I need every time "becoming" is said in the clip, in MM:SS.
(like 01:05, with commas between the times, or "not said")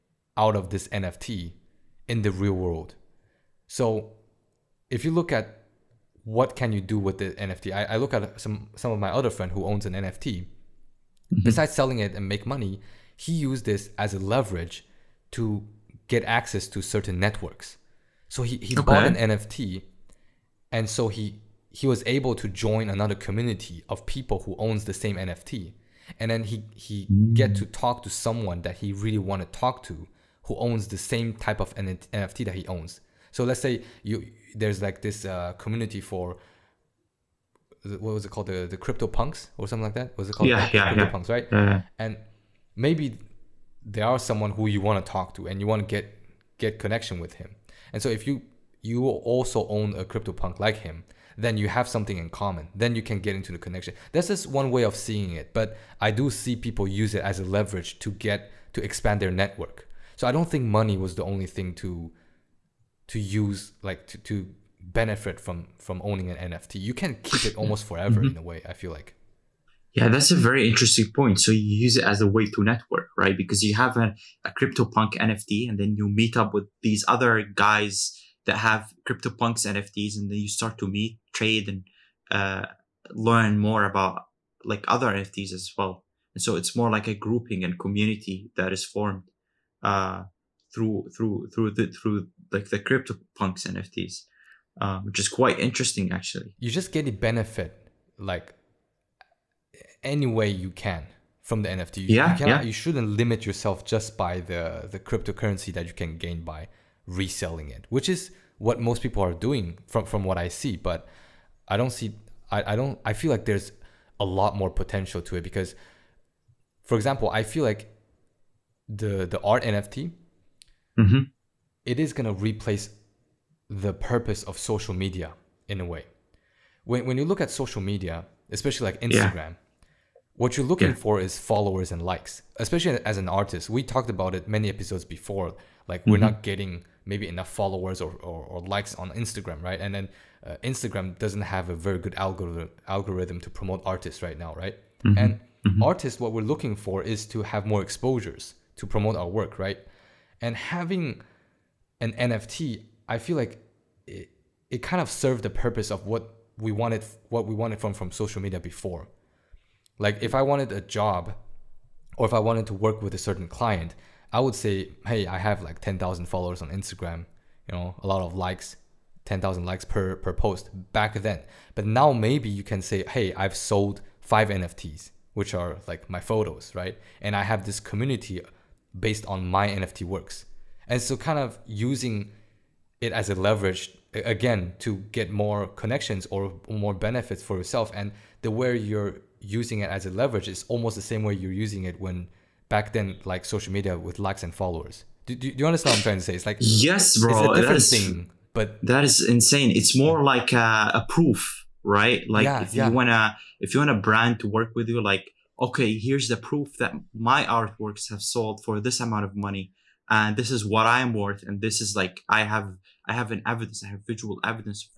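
not said.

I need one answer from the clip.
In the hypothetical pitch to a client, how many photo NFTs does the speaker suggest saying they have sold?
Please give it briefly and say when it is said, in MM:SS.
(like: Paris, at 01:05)
5, at 02:54.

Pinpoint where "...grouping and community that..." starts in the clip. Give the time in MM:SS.
01:27.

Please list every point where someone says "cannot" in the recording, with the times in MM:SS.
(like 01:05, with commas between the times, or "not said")
01:42.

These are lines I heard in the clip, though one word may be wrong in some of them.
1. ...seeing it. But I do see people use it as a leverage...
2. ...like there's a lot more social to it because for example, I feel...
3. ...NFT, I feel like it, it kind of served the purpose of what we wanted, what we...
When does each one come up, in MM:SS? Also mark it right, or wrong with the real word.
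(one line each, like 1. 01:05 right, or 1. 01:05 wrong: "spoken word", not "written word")
1. 00:54 right
2. 01:53 wrong: "potential", not "social"
3. 02:32 right.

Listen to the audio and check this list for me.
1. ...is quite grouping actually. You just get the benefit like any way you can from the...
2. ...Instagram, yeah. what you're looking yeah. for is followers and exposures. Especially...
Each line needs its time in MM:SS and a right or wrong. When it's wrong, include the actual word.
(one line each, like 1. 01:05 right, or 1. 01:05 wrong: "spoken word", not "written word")
1. 01:35 wrong: "interesting", not "grouping"
2. 02:09 wrong: "likes", not "exposures".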